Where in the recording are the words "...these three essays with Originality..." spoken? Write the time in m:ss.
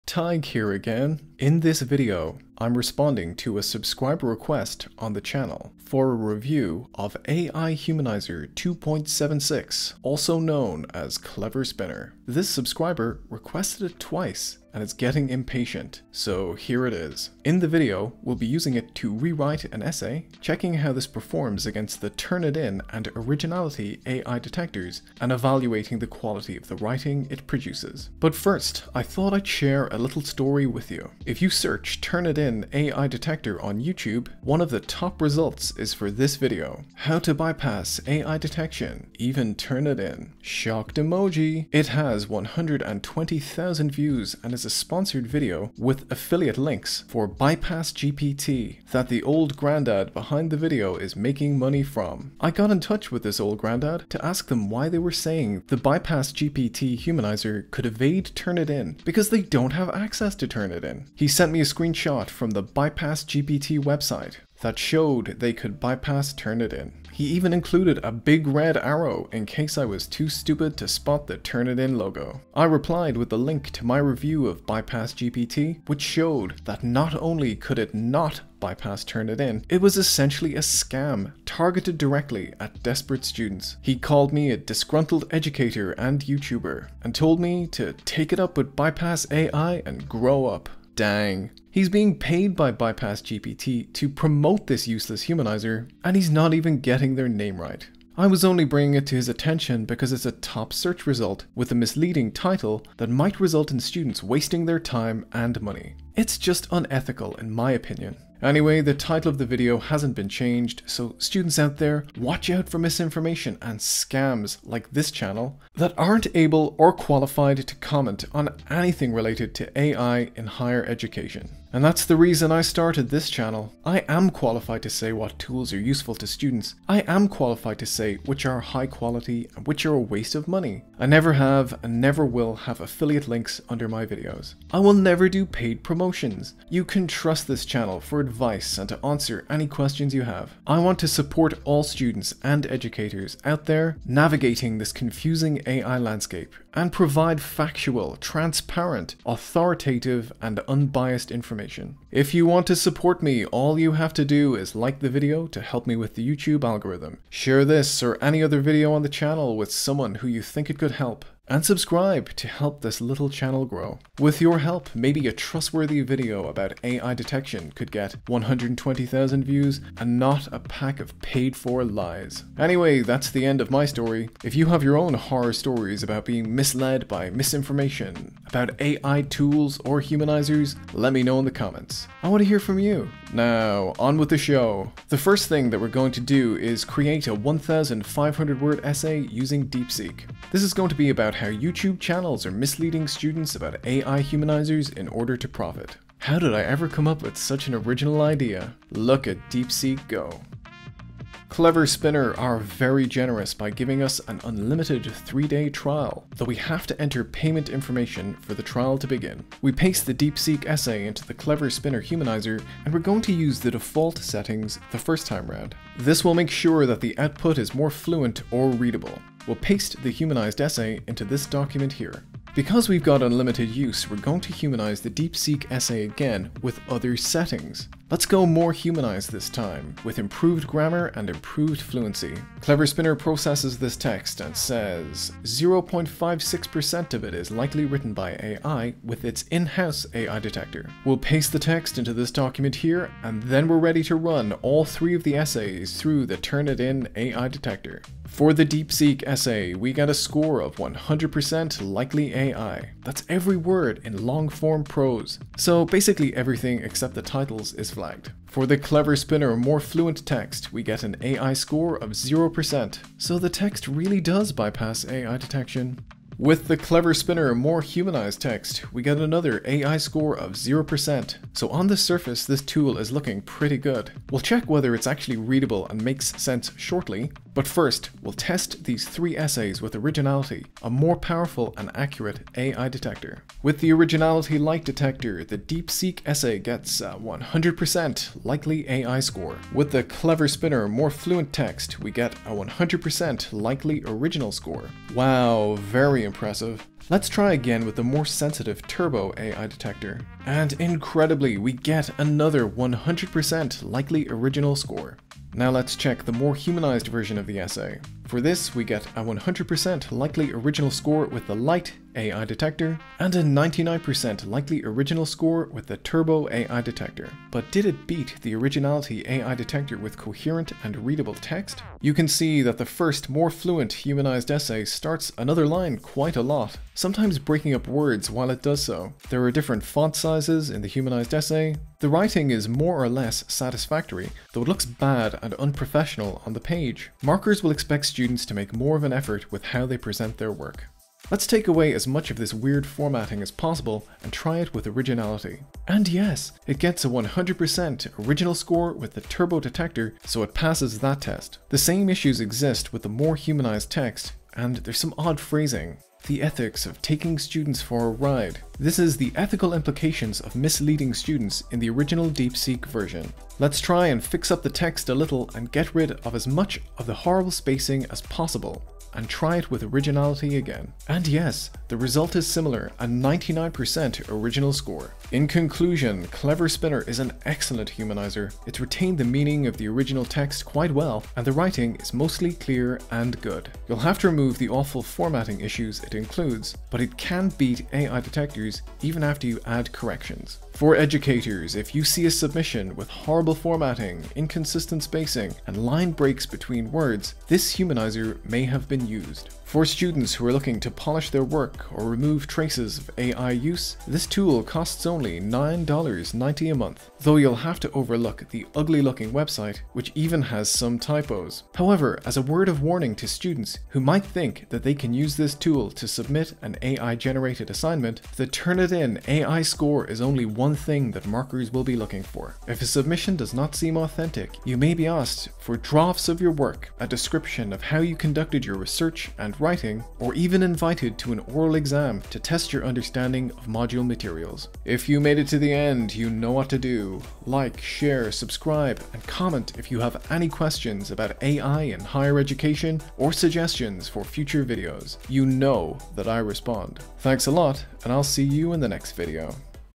4:38.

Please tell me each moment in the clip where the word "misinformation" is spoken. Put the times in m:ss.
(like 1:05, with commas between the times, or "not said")
1:52, 2:57.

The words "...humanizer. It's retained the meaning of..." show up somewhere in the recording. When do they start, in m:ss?
6:17.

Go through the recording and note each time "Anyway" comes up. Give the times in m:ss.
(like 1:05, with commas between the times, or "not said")
1:48, 2:52.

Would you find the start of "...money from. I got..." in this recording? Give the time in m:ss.
0:51.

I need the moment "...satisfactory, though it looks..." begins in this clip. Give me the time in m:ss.
5:33.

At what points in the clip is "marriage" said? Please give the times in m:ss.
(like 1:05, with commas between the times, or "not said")
not said.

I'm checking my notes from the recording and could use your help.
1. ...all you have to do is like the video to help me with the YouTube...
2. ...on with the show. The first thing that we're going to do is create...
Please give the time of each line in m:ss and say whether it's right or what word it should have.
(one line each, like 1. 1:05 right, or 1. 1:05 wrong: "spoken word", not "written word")
1. 2:33 right
2. 3:03 right.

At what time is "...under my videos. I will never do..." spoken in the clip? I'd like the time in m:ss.
2:13.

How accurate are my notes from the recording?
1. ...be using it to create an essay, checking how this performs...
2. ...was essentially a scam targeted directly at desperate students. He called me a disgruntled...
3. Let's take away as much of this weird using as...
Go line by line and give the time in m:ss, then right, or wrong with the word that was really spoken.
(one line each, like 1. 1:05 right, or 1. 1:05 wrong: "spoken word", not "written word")
1. 0:18 wrong: "rewrite", not "create"
2. 1:19 right
3. 5:41 wrong: "formatting", not "using".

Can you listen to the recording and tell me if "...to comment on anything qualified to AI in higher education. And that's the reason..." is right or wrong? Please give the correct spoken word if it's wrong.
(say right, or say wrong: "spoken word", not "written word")
wrong: "related", not "qualified".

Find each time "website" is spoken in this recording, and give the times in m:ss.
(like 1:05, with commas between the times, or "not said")
1:03, 6:49.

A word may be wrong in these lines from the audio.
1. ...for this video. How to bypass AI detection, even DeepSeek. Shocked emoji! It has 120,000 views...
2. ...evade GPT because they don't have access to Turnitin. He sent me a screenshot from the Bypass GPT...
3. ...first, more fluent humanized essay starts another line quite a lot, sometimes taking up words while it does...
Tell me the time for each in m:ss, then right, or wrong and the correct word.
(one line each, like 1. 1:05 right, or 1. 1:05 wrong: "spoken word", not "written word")
1. 0:35 wrong: "Turnitin", not "DeepSeek"
2. 0:57 wrong: "Turnitin", not "GPT"
3. 5:22 wrong: "breaking", not "taking".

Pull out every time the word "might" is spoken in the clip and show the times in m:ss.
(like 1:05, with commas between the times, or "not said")
1:43, 6:54.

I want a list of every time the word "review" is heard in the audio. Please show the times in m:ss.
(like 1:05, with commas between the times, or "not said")
0:06, 1:13.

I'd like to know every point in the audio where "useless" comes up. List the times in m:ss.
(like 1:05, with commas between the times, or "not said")
1:34.